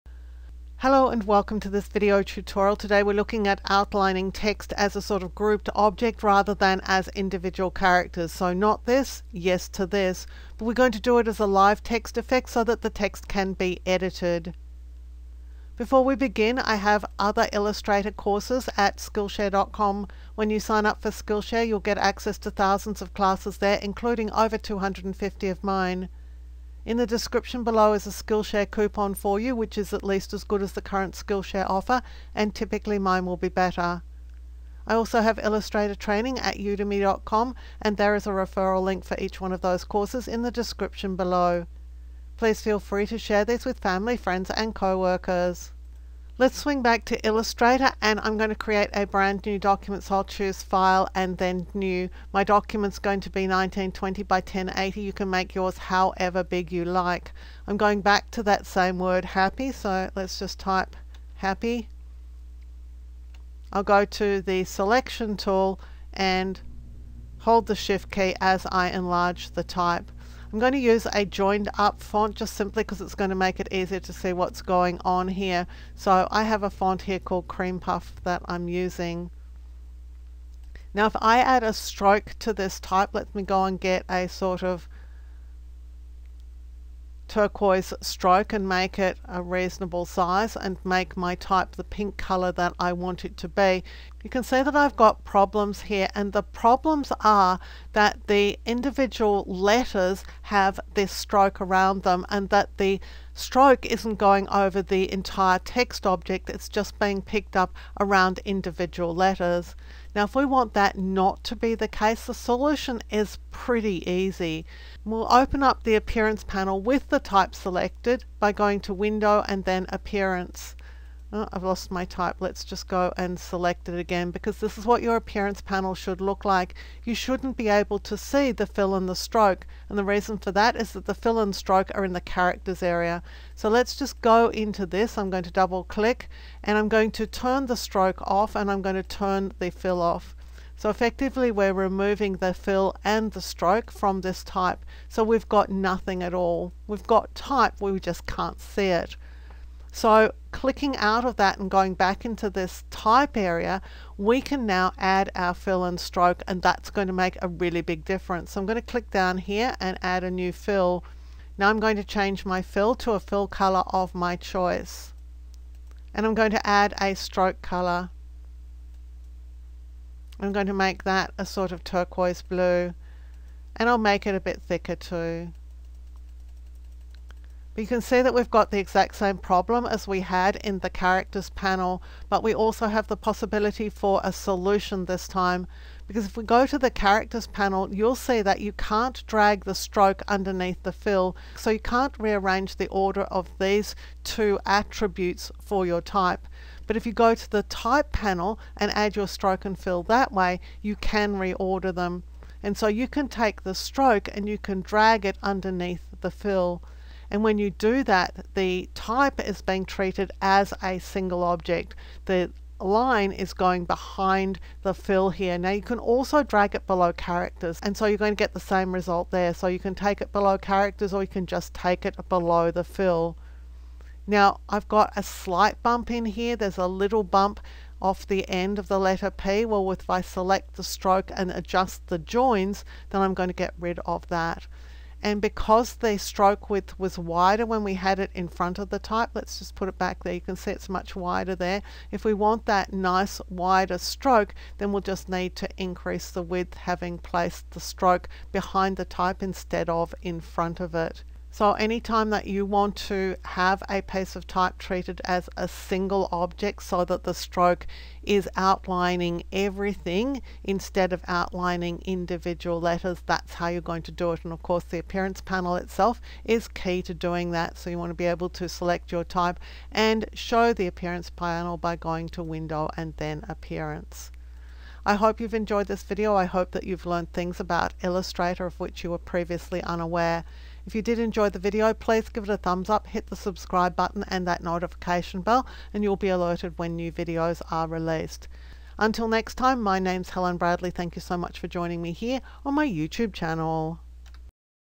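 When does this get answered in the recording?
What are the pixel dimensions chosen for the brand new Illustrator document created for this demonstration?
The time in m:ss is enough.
0:53.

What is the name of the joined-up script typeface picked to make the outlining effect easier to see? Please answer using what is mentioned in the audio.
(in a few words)
Cream Puff.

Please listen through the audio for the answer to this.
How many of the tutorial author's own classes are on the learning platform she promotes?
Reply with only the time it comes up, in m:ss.
0:24.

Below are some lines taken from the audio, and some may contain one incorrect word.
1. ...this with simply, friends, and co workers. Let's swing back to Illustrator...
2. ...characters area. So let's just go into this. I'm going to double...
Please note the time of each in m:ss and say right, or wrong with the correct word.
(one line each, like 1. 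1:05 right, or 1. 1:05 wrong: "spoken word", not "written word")
1. 0:43 wrong: "family", not "simply"
2. 2:12 right.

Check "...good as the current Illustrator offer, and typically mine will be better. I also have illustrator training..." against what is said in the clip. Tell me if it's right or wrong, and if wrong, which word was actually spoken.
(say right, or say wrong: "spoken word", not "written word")
wrong: "Skillshare", not "Illustrator".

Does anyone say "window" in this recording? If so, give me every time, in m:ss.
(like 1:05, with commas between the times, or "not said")
1:58, 4:32.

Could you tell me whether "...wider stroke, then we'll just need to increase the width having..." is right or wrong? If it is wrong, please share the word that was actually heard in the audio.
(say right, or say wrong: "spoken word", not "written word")
right.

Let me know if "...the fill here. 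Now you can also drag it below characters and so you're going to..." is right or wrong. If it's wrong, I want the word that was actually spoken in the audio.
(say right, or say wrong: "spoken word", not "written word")
right.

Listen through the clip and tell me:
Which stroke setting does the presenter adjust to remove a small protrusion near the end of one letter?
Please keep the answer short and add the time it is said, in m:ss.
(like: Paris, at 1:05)
the joins, at 3:52.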